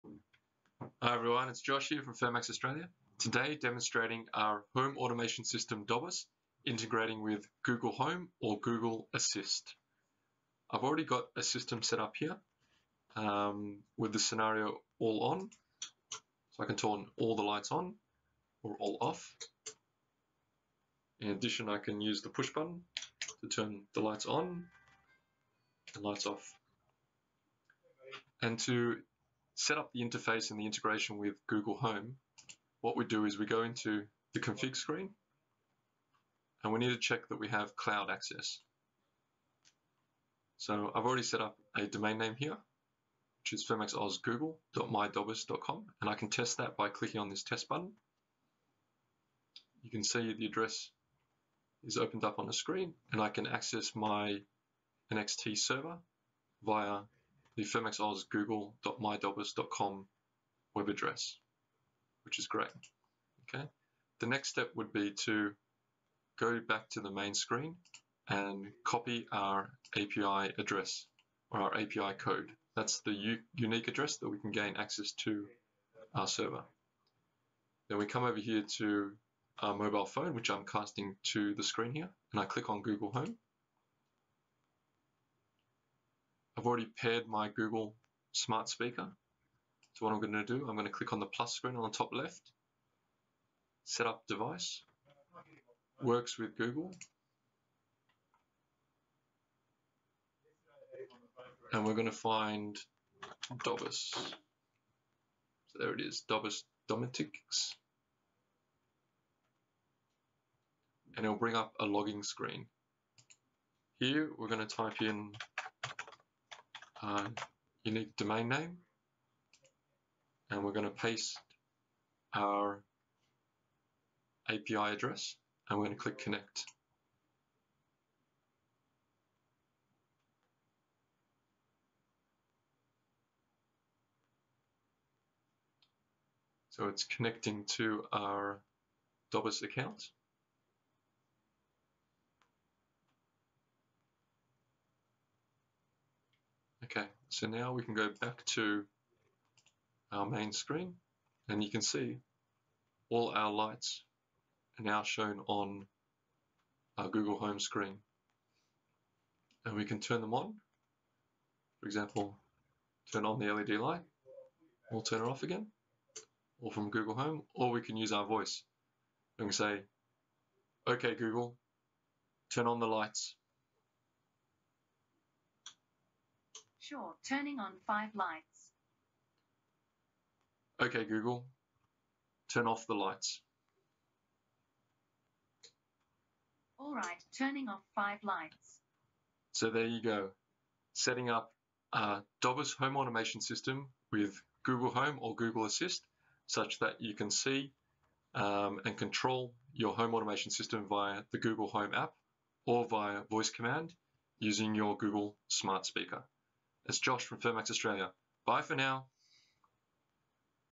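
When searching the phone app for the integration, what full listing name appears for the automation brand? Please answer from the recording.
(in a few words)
DOBISS Domotics.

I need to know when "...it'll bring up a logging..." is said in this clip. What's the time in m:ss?
1:51.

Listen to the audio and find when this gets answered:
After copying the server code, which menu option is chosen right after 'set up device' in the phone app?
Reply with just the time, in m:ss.
1:36.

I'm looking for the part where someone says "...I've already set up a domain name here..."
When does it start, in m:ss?
0:40.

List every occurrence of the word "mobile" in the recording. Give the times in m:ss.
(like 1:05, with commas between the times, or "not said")
1:19.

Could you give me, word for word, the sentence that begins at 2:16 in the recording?
So it's connecting to our DOBISS account.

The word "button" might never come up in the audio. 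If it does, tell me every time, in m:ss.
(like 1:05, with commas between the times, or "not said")
0:22, 0:47.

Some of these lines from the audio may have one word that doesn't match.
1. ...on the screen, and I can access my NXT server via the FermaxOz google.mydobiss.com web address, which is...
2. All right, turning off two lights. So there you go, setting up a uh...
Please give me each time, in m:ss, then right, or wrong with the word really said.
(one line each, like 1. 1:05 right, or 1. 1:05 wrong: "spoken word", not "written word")
1. 0:52 right
2. 3:06 wrong: "five", not "two".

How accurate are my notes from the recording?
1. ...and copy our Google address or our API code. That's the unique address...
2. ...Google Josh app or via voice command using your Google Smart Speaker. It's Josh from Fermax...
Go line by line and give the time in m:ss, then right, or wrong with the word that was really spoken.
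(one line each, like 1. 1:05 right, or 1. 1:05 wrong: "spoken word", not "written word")
1. 1:08 wrong: "API", not "Google"
2. 3:21 wrong: "Home", not "Josh".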